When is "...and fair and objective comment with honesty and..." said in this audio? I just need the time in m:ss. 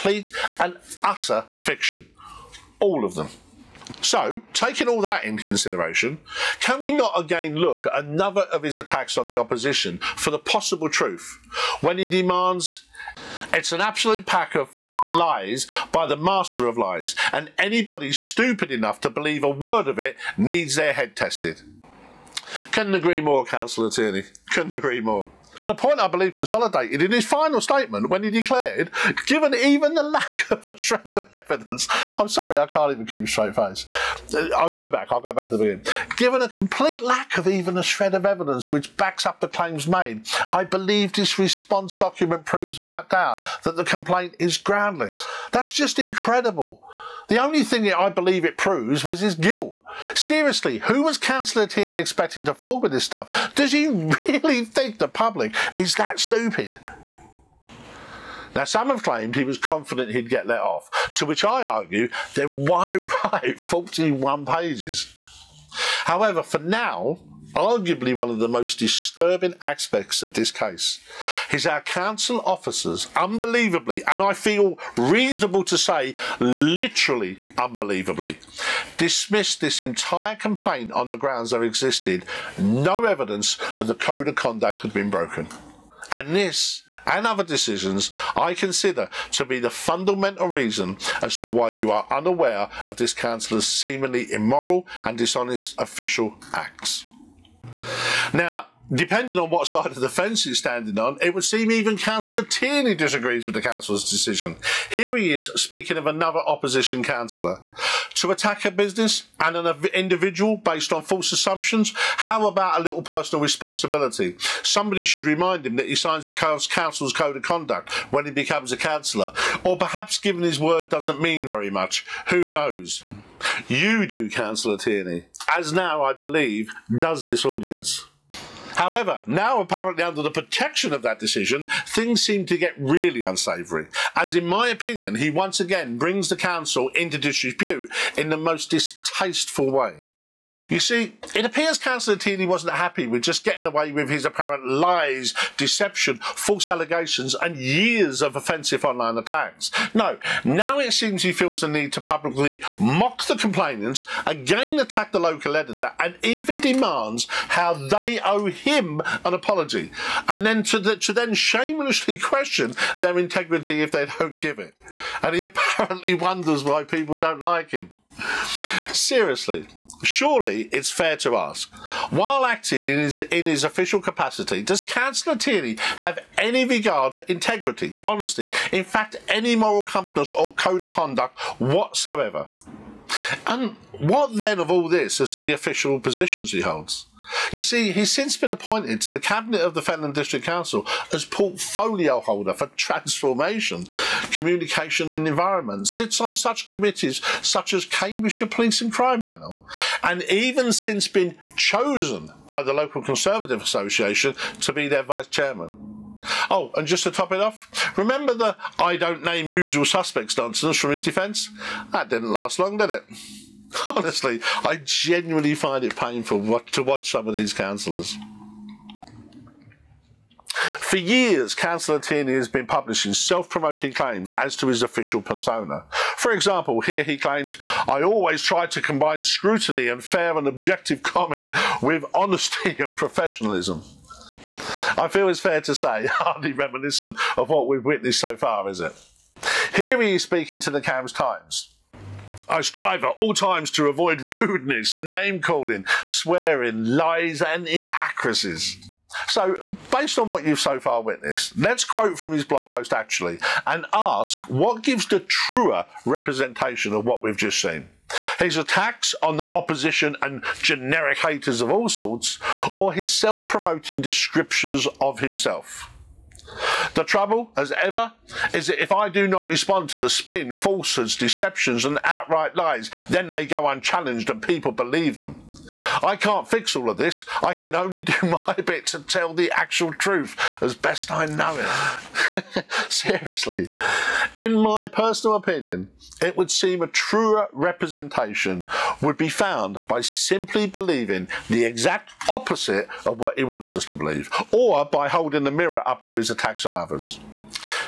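3:49.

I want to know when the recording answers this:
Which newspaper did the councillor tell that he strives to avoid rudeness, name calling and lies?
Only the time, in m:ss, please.
4:00.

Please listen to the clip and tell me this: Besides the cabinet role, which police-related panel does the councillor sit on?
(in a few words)
Cambridgeshire Police and Crime Panel.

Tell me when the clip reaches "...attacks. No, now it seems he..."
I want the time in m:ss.
2:29.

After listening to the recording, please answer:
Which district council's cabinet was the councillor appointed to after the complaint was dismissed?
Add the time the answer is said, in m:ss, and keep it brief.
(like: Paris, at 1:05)
Fenland District Council, at 3:09.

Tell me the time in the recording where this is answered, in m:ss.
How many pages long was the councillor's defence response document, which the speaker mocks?
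1:03.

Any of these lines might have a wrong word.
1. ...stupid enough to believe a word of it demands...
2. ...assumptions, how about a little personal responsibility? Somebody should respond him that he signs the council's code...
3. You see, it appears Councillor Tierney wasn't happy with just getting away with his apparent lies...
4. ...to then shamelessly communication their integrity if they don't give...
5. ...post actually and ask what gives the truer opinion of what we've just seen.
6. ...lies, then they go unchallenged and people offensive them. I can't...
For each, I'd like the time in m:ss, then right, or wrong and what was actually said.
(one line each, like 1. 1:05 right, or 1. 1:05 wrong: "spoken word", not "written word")
1. 0:18 wrong: "needs", not "demands"
2. 1:51 wrong: "remind", not "respond"
3. 2:20 right
4. 2:40 wrong: "question", not "communication"
5. 4:12 wrong: "representation", not "opinion"
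6. 4:32 wrong: "believe", not "offensive".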